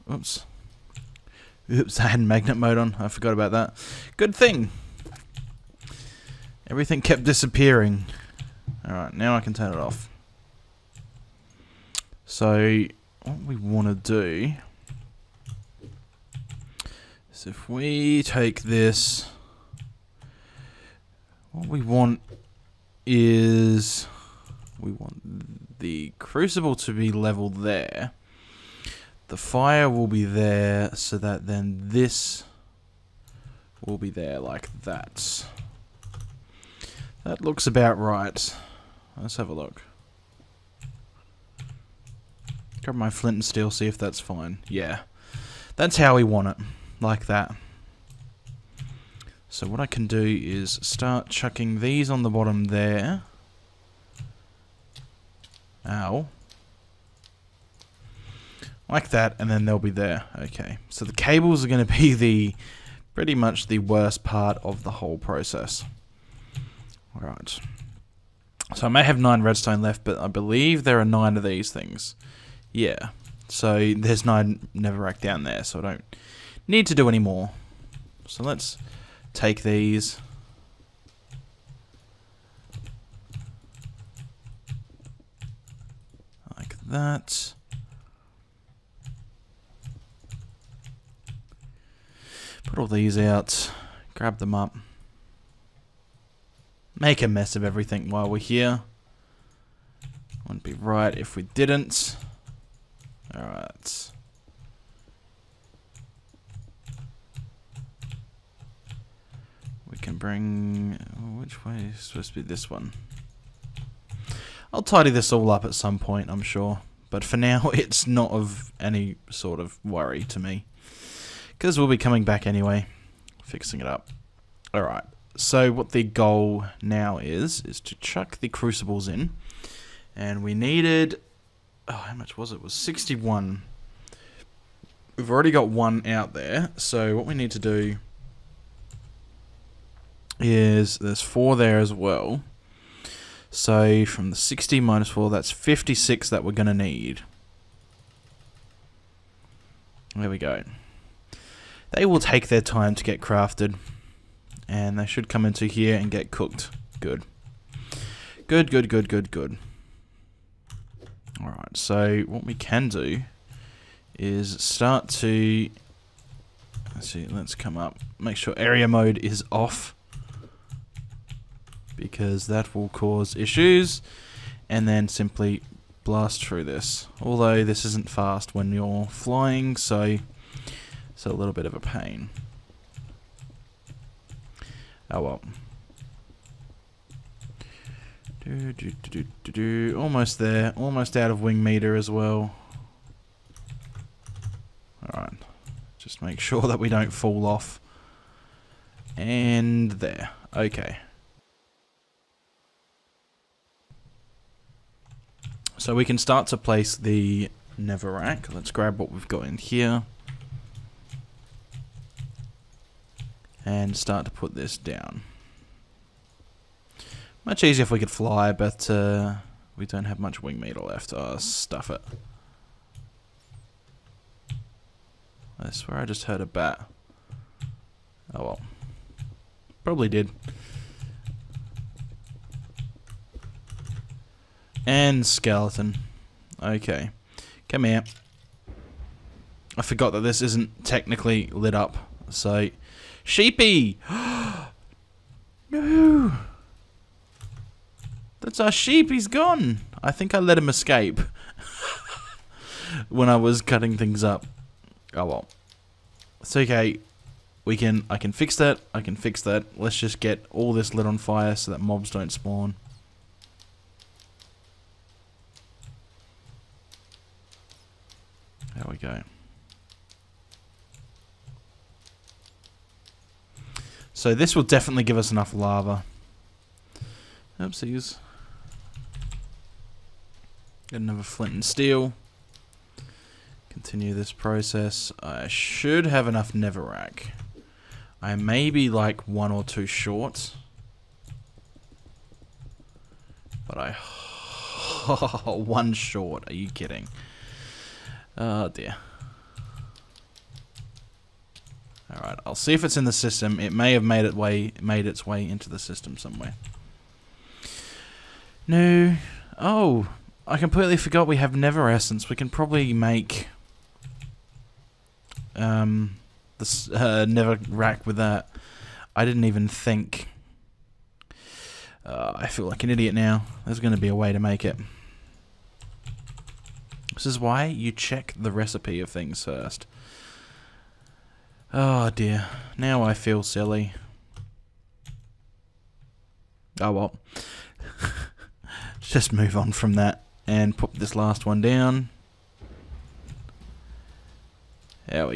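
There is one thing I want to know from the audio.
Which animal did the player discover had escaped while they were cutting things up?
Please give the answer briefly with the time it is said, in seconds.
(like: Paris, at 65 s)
sheep, at 248 s.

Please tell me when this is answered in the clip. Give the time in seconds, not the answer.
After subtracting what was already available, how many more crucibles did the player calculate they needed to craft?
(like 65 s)
145 s.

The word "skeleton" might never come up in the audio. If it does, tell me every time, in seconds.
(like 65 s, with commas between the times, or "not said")
235 s.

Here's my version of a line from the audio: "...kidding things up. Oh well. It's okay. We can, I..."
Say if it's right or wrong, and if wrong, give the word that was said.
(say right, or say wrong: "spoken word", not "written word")
wrong: "cutting", not "kidding".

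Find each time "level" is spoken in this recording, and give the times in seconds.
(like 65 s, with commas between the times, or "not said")
27 s.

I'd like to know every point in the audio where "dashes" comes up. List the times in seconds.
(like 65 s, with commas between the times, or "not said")
not said.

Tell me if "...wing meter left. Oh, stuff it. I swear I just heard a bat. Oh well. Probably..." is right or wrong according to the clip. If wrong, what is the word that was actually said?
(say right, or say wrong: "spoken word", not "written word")
right.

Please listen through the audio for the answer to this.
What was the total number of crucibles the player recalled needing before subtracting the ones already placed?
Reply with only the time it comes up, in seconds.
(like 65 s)
132 s.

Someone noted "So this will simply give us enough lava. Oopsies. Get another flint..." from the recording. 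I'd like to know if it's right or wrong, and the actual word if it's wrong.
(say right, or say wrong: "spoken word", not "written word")
wrong: "definitely", not "simply".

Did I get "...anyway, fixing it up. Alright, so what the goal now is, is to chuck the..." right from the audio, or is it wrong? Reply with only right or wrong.
right.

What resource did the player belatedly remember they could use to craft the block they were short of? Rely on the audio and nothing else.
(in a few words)
nether essence.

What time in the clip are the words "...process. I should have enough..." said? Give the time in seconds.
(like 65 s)
284 s.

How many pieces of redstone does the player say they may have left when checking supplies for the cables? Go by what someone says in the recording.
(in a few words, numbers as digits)
9.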